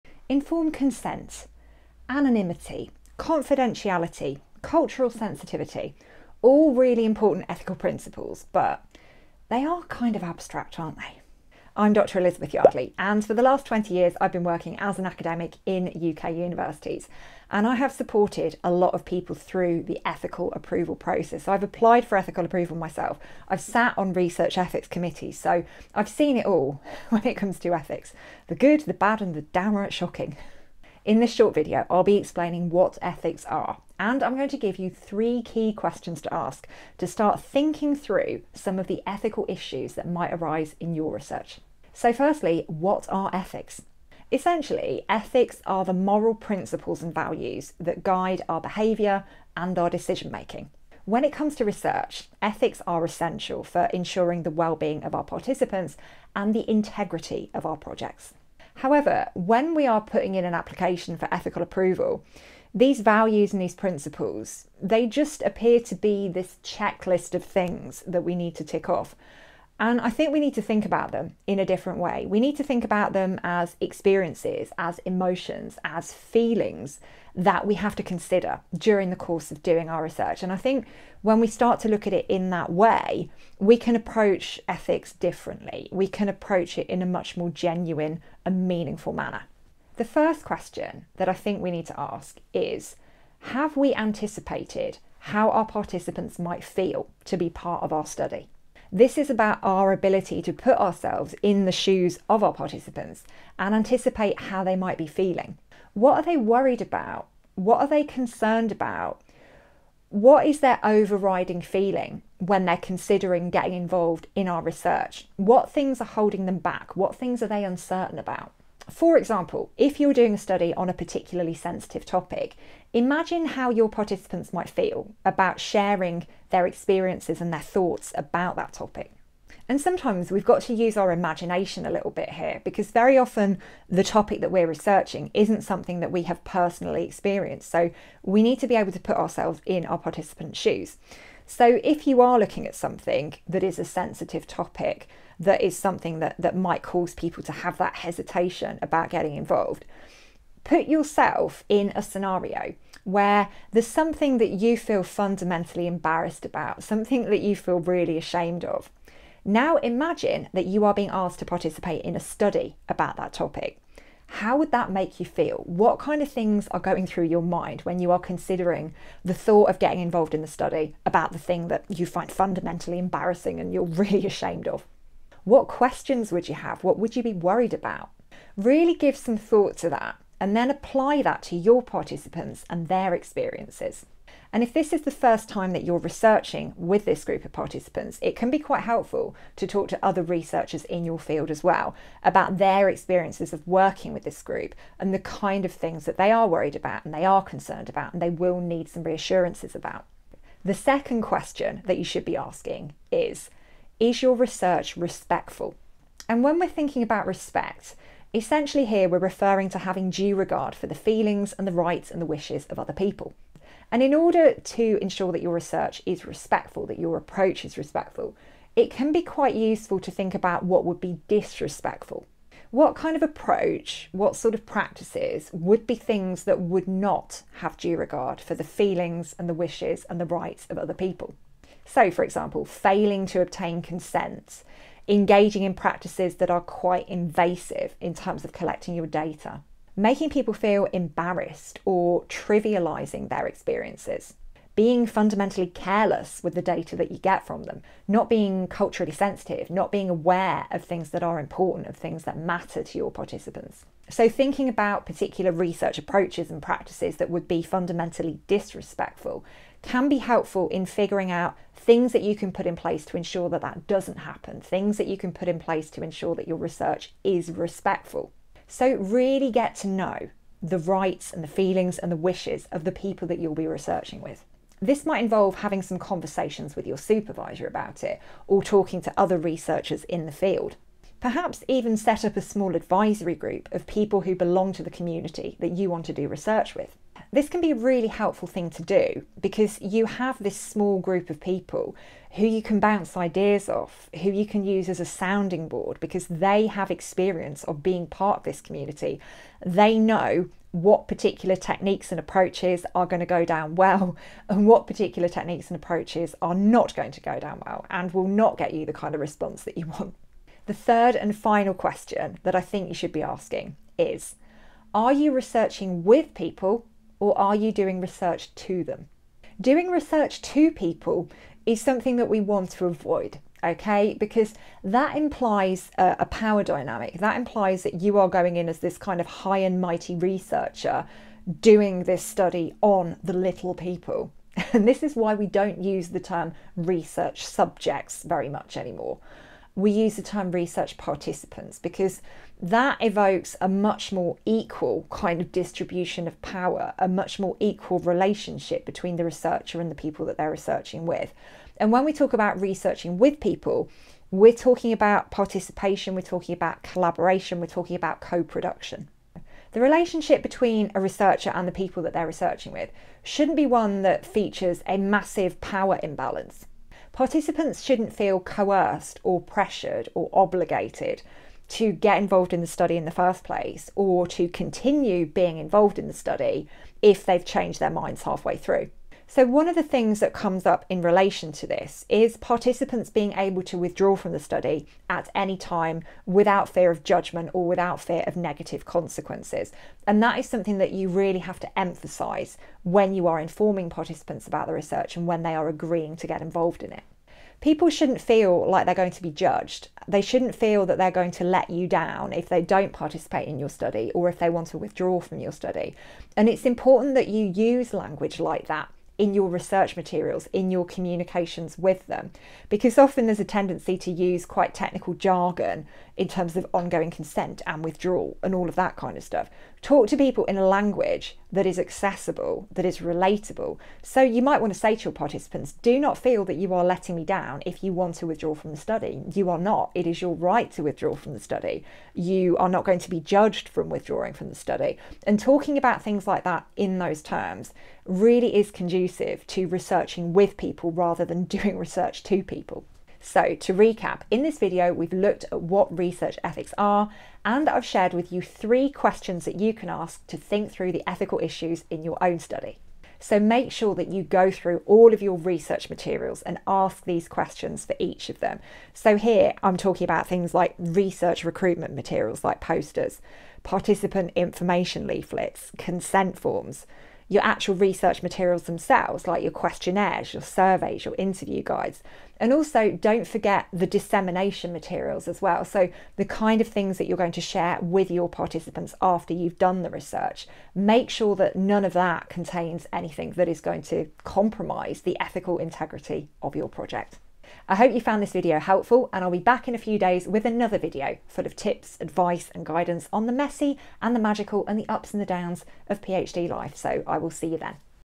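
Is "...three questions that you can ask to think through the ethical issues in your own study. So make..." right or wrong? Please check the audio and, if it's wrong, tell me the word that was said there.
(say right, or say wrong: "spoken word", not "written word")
right.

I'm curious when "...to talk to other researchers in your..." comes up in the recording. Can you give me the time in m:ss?
3:09.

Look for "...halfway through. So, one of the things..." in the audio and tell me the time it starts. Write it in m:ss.
6:18.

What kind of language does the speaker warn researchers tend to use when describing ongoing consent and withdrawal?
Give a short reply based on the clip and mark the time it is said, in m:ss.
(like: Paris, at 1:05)
Technical jargon, at 6:54.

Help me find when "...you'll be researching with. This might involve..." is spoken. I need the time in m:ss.
4:33.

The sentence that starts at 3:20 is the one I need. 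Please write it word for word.
The second question that you should be asking is Is your research respectful?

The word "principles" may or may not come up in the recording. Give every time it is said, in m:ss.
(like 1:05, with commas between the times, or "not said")
0:07, 0:46, 1:03.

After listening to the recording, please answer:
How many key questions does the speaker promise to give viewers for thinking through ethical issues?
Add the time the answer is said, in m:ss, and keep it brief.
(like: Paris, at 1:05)
3, at 0:34.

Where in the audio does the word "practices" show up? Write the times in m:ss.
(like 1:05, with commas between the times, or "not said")
3:44, 3:55, 4:16.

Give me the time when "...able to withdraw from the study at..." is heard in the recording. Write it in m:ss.
6:23.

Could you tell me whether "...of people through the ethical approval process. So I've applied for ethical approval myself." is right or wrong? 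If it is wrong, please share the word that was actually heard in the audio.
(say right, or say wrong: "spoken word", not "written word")
right.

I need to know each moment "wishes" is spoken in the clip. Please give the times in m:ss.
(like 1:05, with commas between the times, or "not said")
3:32, 3:49, 4:32.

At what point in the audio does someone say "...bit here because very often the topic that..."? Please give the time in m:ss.
2:12.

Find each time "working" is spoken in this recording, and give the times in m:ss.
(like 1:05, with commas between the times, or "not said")
0:14, 3:13.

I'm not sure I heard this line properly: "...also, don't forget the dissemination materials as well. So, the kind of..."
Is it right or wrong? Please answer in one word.
right.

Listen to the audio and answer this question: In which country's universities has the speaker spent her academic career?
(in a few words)
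UK.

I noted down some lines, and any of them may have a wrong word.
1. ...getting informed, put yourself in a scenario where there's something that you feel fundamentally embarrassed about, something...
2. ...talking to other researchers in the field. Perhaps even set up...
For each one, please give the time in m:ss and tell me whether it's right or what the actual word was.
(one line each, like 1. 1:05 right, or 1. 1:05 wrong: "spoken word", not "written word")
1. 2:29 wrong: "involved", not "informed"
2. 4:38 right.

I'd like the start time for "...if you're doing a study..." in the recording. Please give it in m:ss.
1:59.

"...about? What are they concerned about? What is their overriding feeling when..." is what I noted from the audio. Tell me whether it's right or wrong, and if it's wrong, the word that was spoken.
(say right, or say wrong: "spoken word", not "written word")
right.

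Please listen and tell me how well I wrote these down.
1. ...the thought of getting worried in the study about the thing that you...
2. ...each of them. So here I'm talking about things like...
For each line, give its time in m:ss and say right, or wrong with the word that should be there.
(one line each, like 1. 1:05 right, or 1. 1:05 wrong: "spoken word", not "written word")
1. 2:49 wrong: "involved", not "worried"
2. 7:37 right.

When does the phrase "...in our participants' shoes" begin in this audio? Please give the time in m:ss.
2:19.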